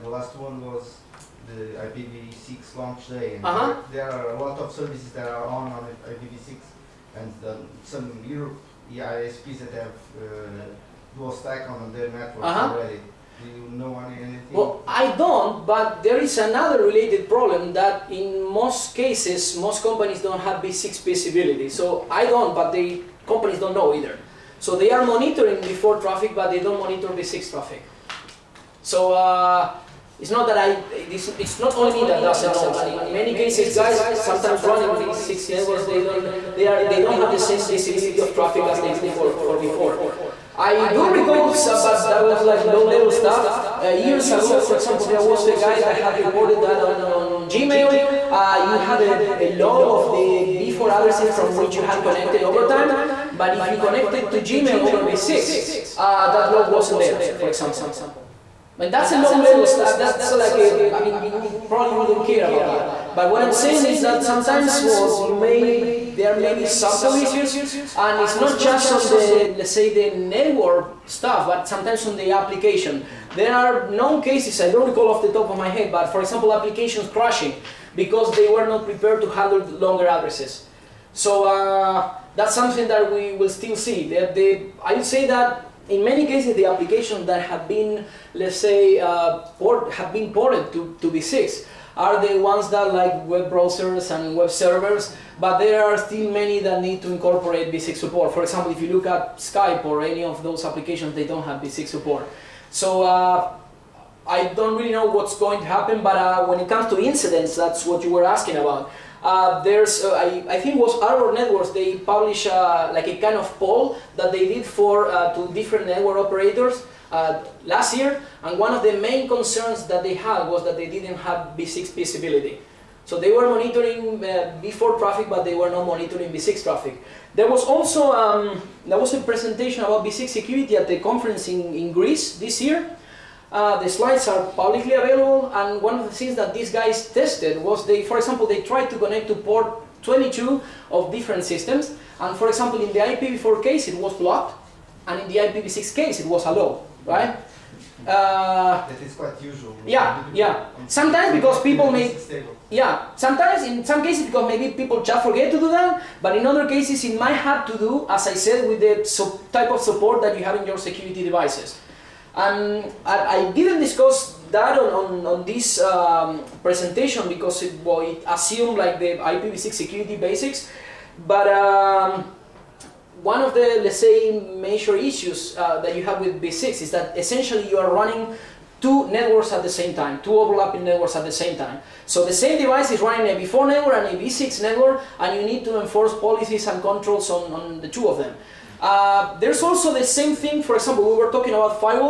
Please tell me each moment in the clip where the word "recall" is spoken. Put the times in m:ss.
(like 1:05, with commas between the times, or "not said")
0:41, 1:14.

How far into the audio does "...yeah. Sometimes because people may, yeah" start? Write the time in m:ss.
2:30.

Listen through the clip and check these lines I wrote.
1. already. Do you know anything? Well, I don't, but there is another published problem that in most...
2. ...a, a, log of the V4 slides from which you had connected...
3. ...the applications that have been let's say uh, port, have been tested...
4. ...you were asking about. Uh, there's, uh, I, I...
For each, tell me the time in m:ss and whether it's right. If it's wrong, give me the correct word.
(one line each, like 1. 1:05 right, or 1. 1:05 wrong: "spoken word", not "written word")
1. 0:12 wrong: "related", not "published"
2. 0:49 wrong: "addresses", not "slides"
3. 1:26 wrong: "ported", not "tested"
4. 1:48 right.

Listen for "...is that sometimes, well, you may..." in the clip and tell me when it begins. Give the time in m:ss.
1:03.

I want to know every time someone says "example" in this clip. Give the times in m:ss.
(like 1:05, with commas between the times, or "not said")
0:44, 0:57, 1:16, 1:38, 2:18, 2:22, 3:10.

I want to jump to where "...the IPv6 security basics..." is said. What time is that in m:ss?
2:48.